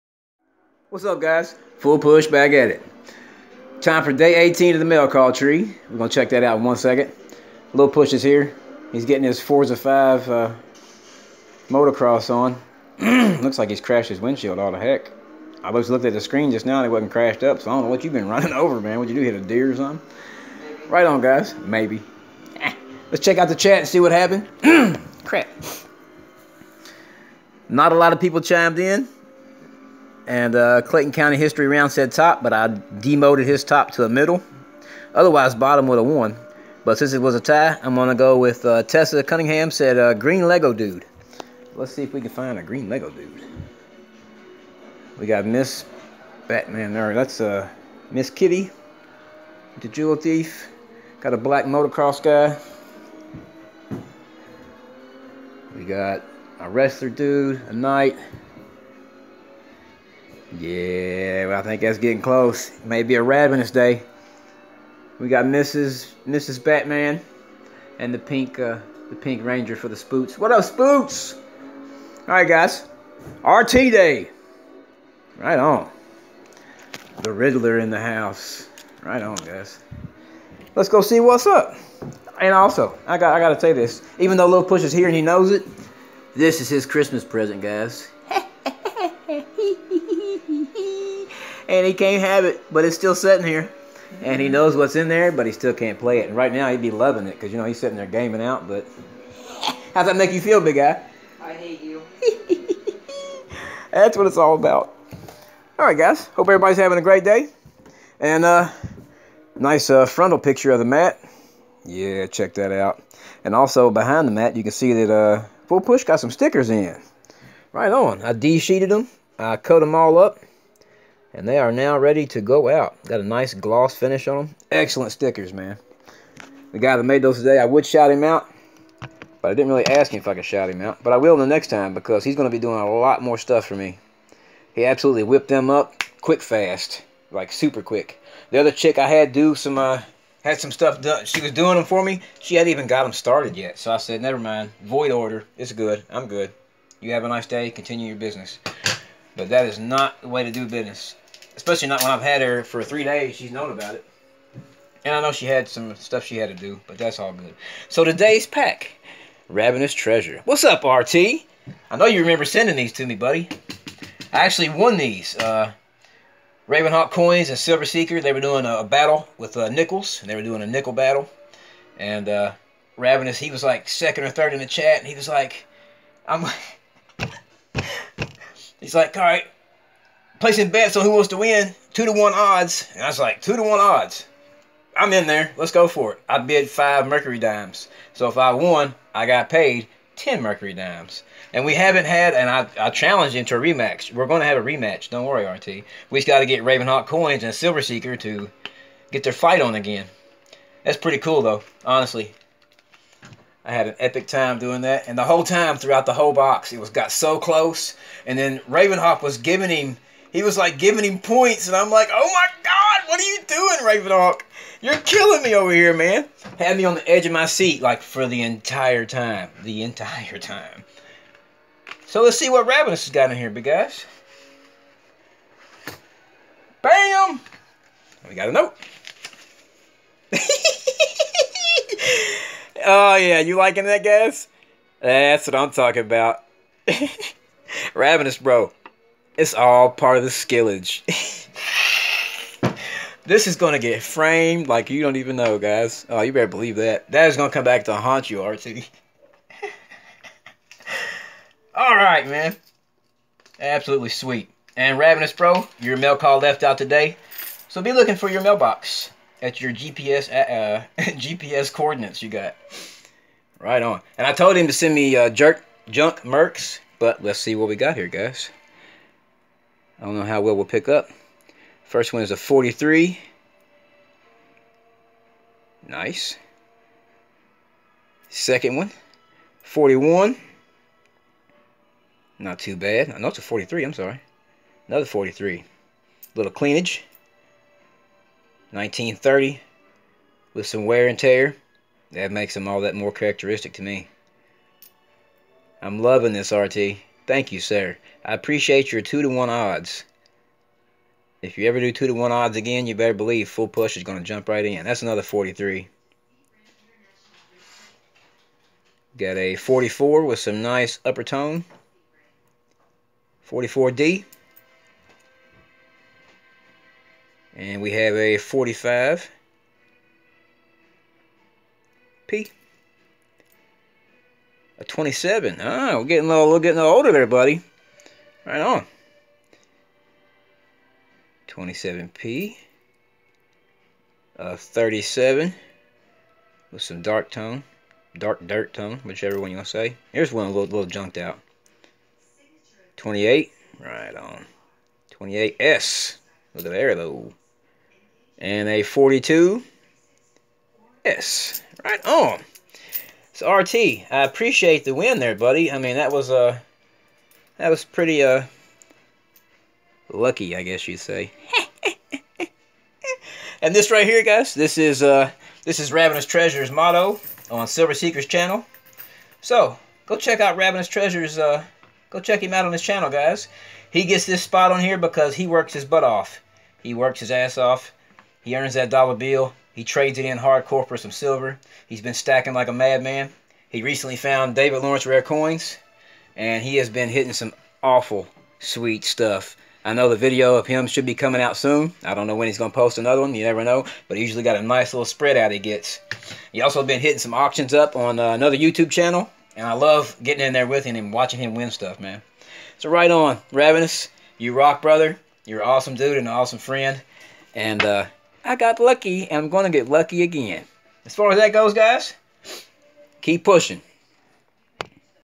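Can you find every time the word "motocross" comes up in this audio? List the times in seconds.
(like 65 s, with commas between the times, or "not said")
11 s, 51 s.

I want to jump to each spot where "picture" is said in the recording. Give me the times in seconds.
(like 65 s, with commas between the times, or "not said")
110 s.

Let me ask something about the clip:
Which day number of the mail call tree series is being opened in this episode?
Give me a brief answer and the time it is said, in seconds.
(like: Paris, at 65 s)
18, at 4 s.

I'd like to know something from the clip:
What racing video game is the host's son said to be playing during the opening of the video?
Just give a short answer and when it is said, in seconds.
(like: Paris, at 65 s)
Forza 5, at 9 s.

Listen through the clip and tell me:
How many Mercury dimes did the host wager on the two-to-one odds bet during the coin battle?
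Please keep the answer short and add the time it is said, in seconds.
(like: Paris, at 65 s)
5, at 186 s.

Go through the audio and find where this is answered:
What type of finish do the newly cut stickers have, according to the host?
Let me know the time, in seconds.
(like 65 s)
123 s.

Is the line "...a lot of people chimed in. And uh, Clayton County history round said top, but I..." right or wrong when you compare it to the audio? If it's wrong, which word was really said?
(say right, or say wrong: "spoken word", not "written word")
right.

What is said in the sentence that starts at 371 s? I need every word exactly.
Uh, go check him out on his channel, guys.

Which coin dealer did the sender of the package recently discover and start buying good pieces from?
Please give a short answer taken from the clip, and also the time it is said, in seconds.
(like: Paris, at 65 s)
David Lawrence rare coins, at 384 s.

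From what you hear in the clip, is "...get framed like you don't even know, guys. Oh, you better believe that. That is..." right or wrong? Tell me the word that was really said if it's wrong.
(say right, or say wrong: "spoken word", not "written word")
right.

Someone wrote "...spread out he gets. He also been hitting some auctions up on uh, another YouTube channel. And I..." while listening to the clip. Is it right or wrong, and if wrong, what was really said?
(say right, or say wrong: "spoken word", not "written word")
right.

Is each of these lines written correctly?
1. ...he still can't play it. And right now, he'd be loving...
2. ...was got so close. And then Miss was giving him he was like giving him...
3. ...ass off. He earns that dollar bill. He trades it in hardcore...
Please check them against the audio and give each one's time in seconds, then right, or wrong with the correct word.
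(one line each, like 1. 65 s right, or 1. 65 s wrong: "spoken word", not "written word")
1. 95 s right
2. 206 s wrong: "Ravenhawk", not "Miss"
3. 377 s right.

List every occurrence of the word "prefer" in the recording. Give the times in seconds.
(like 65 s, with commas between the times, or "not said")
not said.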